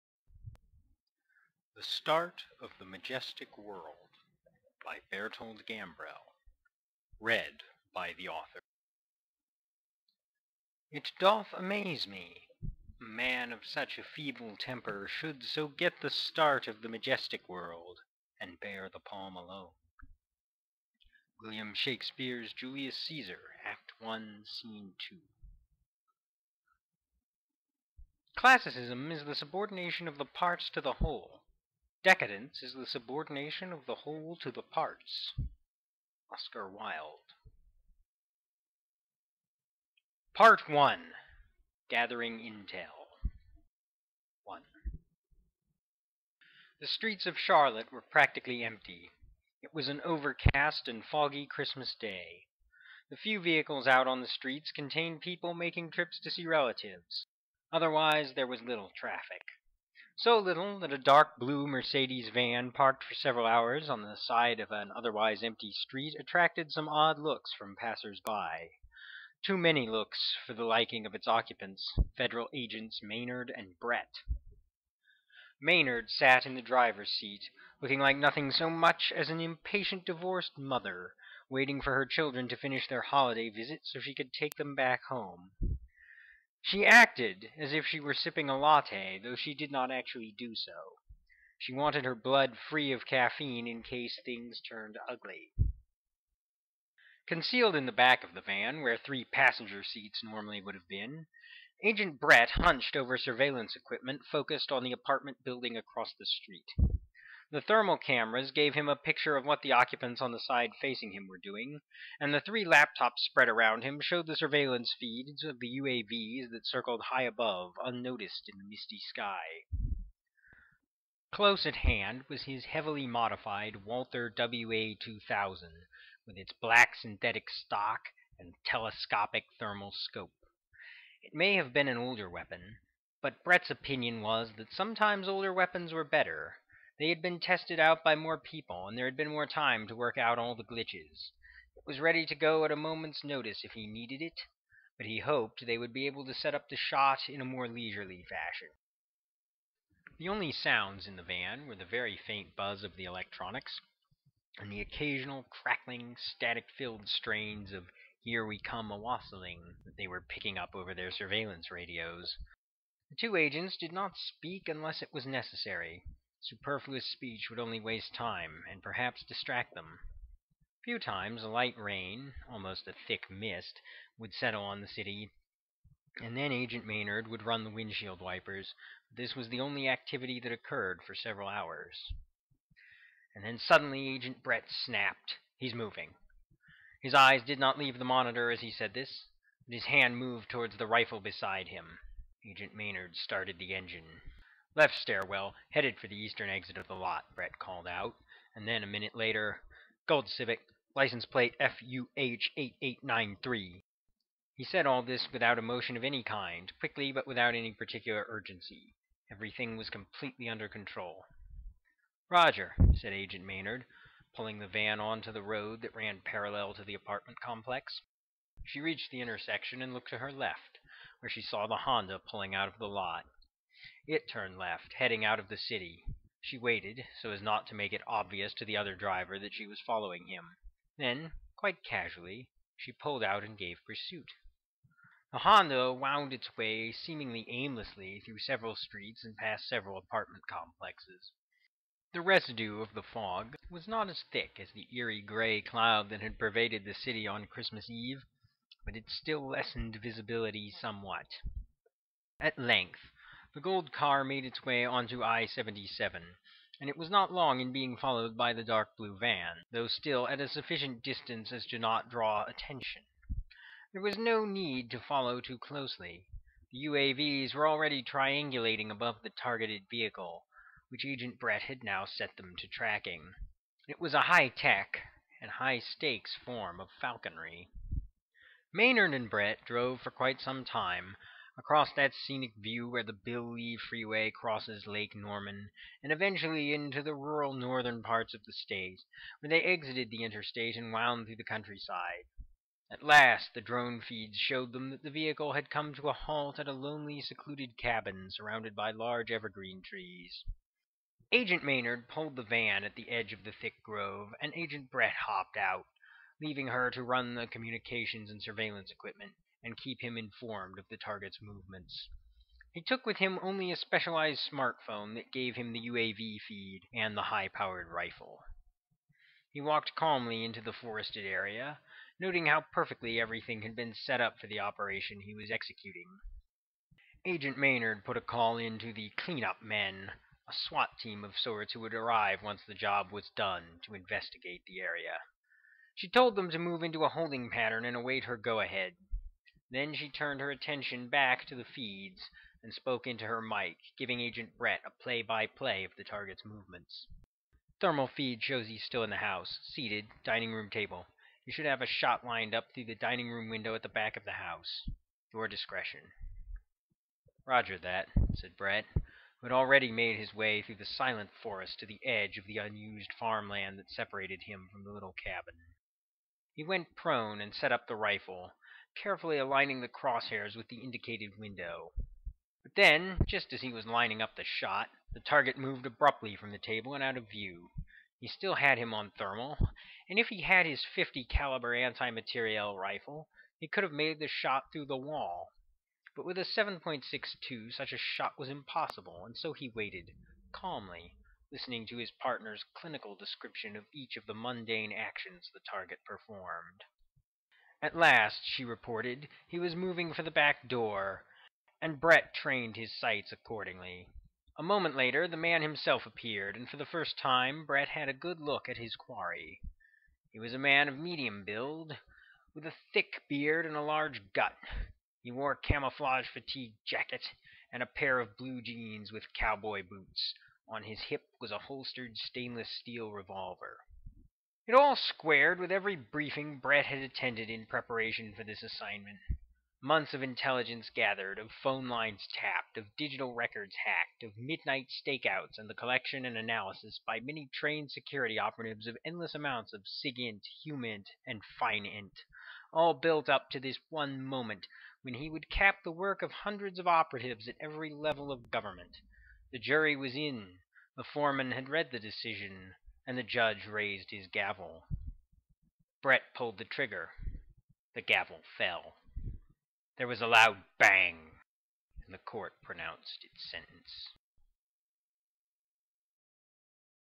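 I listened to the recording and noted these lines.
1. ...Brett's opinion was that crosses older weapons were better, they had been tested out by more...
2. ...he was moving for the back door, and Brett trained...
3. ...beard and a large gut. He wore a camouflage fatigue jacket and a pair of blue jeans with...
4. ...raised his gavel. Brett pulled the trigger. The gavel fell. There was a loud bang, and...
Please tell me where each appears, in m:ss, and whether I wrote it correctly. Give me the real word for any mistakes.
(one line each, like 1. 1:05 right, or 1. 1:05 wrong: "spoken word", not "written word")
1. 2:13 wrong: "sometimes", not "crosses"
2. 6:39 right
3. 6:53 right
4. 7:33 right.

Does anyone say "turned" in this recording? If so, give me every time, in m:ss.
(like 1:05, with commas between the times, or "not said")
1:34, 3:44, 5:40.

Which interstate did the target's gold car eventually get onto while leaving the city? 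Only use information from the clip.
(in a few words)
I-77.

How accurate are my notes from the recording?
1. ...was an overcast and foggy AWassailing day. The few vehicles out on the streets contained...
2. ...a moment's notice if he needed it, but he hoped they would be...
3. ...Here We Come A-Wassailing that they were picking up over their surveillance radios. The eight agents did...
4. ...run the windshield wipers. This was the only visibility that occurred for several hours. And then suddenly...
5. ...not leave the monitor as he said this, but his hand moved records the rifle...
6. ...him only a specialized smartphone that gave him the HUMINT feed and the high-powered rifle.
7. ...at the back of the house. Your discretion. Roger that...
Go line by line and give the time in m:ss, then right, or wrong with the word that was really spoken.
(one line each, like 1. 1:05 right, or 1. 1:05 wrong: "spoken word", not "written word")
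1. 0:49 wrong: "Christmas", not "AWassailing"
2. 2:22 right
3. 2:38 wrong: "two", not "eight"
4. 2:57 wrong: "activity", not "visibility"
5. 3:07 wrong: "towards", not "records"
6. 5:13 wrong: "UAV", not "HUMINT"
7. 5:53 right.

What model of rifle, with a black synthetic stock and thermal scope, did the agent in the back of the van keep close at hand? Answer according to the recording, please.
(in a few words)
Walther WA 2000.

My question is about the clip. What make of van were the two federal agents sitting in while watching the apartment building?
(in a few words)
Mercedes.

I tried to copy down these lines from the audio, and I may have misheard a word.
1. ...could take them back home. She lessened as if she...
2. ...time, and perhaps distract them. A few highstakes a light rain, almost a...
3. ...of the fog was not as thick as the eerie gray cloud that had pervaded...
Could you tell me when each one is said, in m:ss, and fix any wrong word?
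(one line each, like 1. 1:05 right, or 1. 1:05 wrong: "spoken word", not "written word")
1. 1:24 wrong: "acted", not "lessened"
2. 2:48 wrong: "times", not "highstakes"
3. 4:02 right.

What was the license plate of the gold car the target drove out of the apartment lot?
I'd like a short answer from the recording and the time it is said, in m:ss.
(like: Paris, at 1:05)
FUH8893, at 3:21.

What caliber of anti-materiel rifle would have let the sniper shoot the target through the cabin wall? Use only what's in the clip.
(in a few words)
50 caliber.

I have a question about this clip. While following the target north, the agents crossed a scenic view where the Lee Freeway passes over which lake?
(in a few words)
Lake Norman.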